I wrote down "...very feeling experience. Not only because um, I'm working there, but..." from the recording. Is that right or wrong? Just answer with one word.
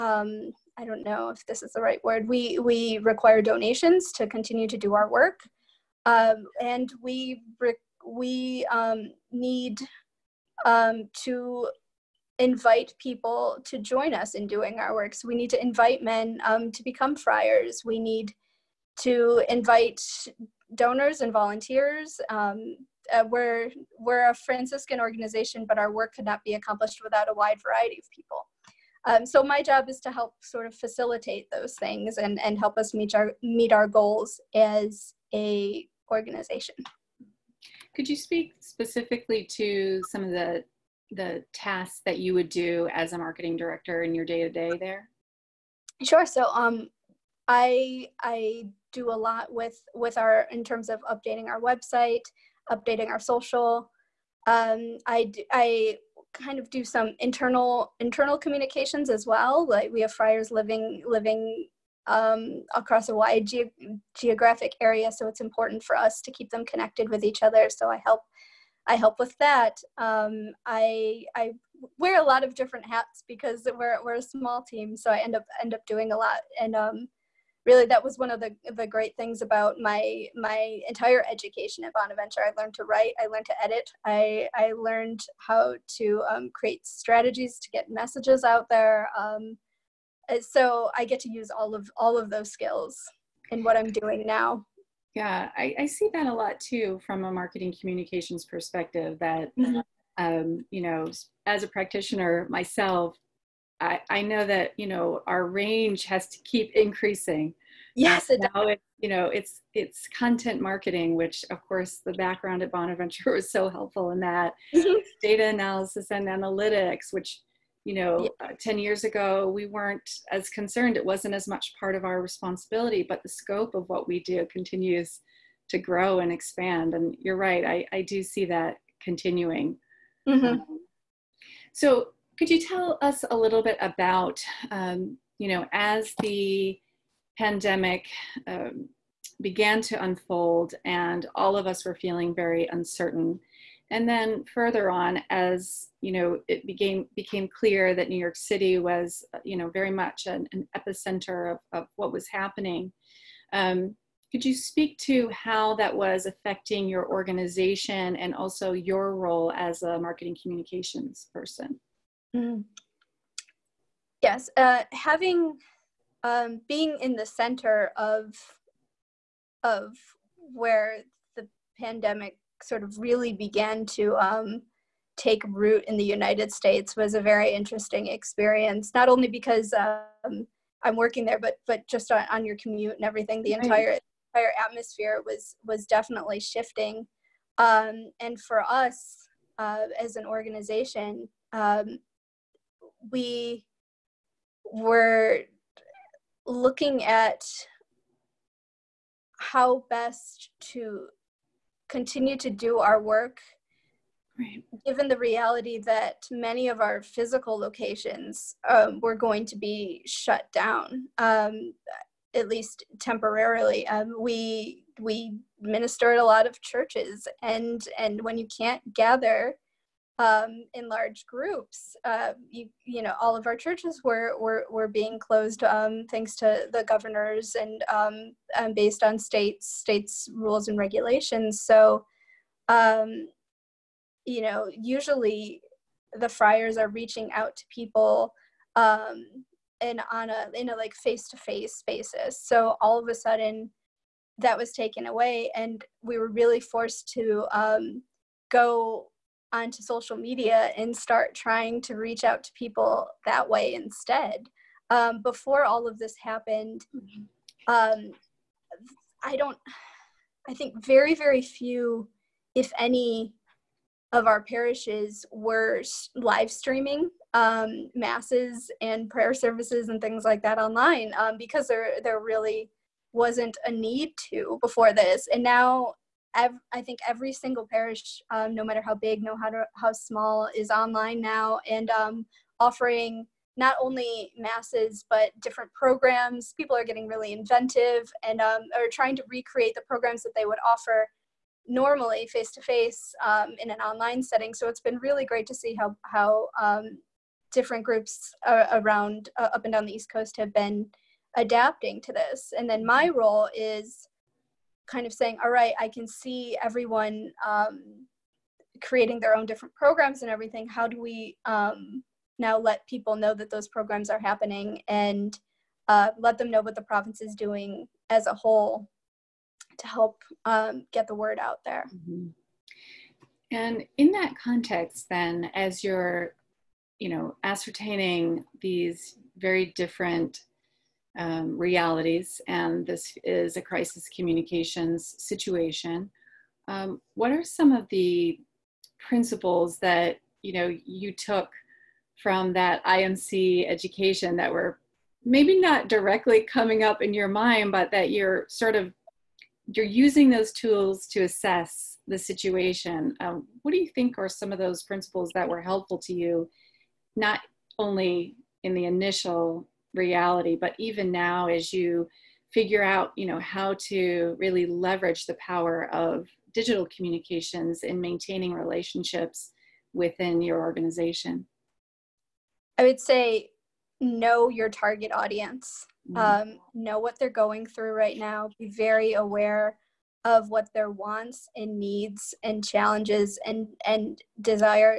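wrong.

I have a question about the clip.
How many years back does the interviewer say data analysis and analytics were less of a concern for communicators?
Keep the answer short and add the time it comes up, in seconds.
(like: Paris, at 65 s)
10, at 118 s.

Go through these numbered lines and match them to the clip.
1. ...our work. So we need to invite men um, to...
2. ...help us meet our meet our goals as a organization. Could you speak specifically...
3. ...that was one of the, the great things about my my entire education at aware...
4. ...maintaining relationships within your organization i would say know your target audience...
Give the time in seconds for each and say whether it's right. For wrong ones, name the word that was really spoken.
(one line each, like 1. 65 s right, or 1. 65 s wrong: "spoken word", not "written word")
1. 14 s right
2. 32 s right
3. 77 s wrong: "bonaventure", not "aware"
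4. 367 s right.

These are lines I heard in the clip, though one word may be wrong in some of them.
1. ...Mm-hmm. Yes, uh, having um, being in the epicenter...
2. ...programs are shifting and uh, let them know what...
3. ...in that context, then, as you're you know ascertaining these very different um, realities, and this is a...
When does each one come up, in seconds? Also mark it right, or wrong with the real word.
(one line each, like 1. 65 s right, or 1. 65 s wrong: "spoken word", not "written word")
1. 162 s wrong: "center", not "epicenter"
2. 313 s wrong: "happening", not "shifting"
3. 323 s right.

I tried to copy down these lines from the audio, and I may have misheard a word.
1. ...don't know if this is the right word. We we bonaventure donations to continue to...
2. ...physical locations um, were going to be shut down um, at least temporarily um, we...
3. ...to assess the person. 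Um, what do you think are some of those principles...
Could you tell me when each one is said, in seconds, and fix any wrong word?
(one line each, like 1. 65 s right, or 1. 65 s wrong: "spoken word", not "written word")
1. 0 s wrong: "require", not "bonaventure"
2. 207 s right
3. 351 s wrong: "situation", not "person".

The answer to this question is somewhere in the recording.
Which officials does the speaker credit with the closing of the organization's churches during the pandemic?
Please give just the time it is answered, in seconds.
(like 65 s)
226 s.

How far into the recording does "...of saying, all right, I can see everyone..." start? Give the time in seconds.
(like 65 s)
305 s.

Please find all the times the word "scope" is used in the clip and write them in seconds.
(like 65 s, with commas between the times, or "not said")
123 s.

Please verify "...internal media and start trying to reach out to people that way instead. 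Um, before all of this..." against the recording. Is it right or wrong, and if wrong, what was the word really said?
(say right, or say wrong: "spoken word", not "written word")
wrong: "social", not "internal".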